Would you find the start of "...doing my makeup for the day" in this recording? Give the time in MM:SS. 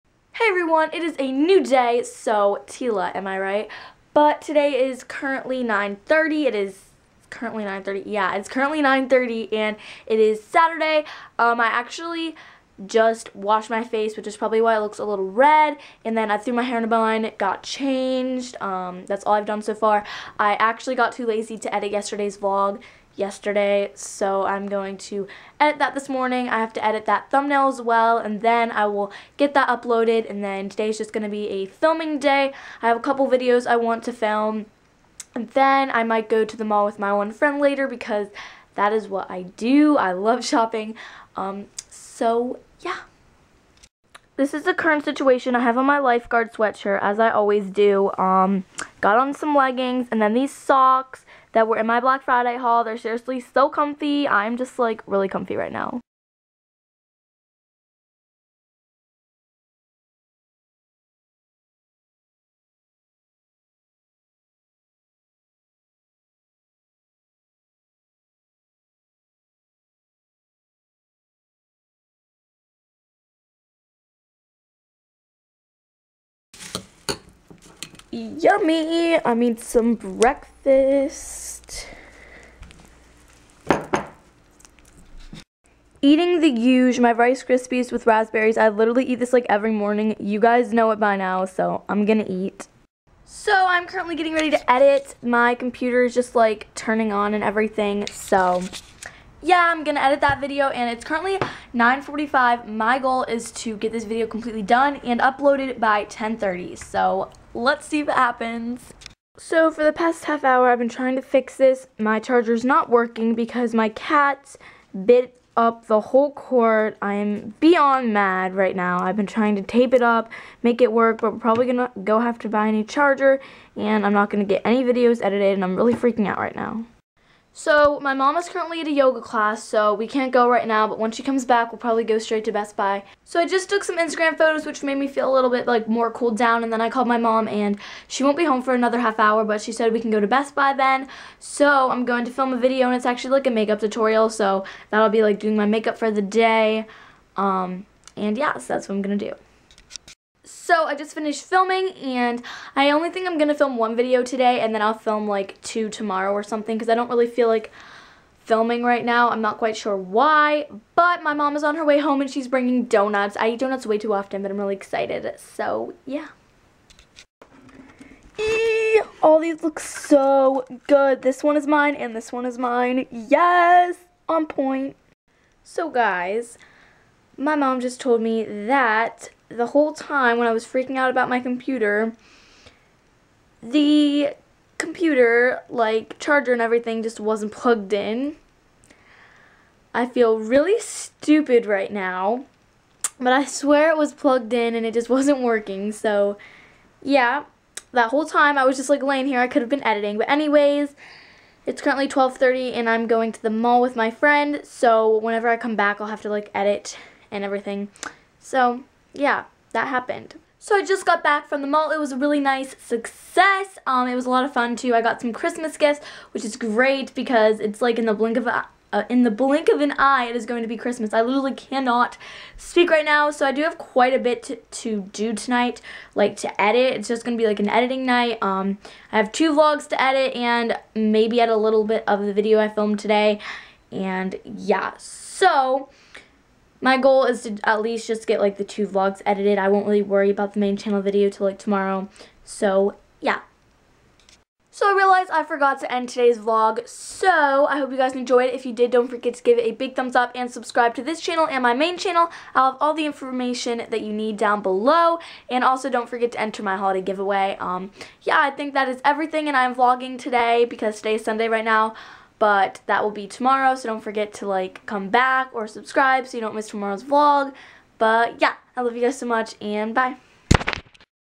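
02:25.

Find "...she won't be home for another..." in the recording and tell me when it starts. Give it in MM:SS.
02:18.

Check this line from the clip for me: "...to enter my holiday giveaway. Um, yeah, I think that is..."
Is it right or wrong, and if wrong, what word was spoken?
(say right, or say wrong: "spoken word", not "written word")
right.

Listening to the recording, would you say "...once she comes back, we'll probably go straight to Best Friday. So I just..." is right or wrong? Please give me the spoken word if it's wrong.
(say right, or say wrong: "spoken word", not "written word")
wrong: "Buy", not "Friday".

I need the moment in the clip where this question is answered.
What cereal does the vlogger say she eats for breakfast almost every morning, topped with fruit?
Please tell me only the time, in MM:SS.
01:27.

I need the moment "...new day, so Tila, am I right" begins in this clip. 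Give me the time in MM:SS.
00:01.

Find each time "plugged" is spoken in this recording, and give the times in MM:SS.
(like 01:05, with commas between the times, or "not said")
03:07, 03:14.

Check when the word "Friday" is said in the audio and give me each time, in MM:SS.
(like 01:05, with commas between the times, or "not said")
00:52.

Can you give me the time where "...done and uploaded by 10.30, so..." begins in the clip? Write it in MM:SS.
01:44.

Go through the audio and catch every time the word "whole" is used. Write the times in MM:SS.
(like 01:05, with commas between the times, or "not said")
01:55, 02:59, 03:18.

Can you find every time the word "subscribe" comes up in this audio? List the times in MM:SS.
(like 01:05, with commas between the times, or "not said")
04:10, 04:25.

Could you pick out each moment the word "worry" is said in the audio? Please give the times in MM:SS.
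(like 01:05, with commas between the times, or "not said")
04:00.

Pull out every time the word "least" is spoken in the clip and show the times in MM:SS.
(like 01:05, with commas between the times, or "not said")
03:57.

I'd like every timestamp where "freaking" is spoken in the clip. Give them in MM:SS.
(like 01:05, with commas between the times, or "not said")
02:05, 03:00.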